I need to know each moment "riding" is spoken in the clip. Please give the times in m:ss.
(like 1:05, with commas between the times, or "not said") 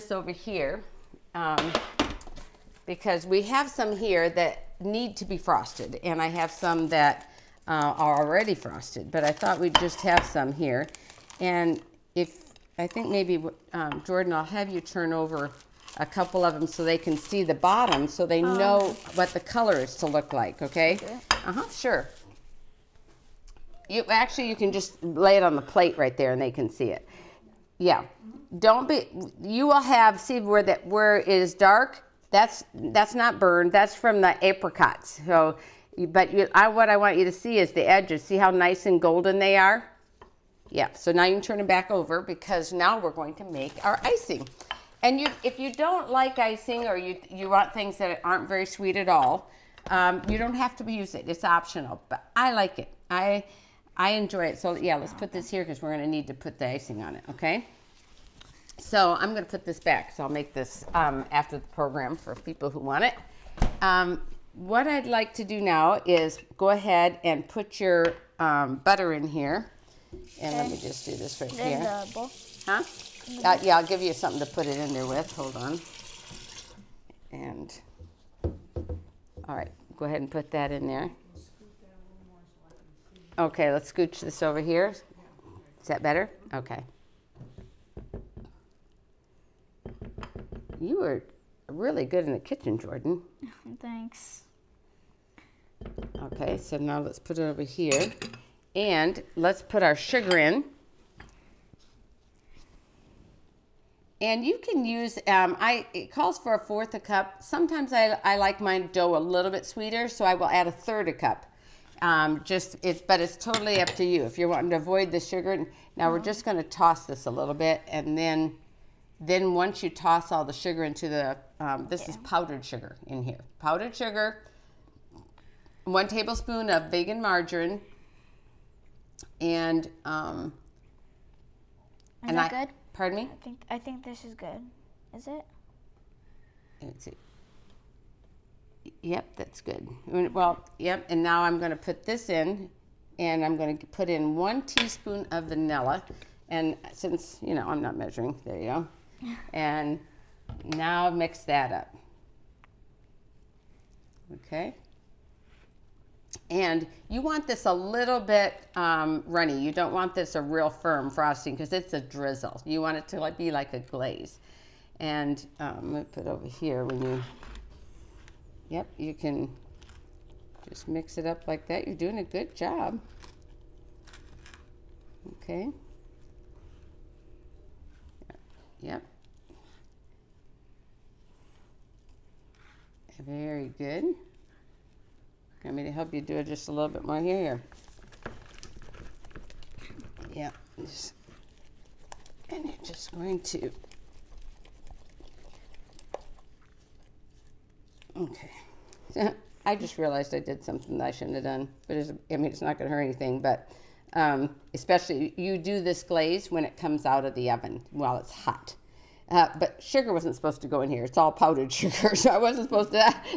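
not said.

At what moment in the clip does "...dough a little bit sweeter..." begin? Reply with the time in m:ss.
1:48.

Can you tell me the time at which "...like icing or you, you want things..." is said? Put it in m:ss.
0:46.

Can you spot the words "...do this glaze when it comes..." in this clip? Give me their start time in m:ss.
3:25.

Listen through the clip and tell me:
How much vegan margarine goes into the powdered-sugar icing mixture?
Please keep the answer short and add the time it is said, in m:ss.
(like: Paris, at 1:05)
1 tablespoon, at 2:05.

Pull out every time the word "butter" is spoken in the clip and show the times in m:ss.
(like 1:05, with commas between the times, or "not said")
1:08.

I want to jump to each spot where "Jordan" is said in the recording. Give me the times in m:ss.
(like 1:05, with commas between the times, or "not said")
0:14, 1:32.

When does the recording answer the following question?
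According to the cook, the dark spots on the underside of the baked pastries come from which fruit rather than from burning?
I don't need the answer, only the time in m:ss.
0:34.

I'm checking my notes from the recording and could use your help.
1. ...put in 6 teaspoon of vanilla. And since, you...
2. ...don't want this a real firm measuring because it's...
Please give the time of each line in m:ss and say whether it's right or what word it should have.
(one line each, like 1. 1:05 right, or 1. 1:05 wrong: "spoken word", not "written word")
1. 2:23 wrong: "1", not "6"
2. 2:39 wrong: "frosting", not "measuring".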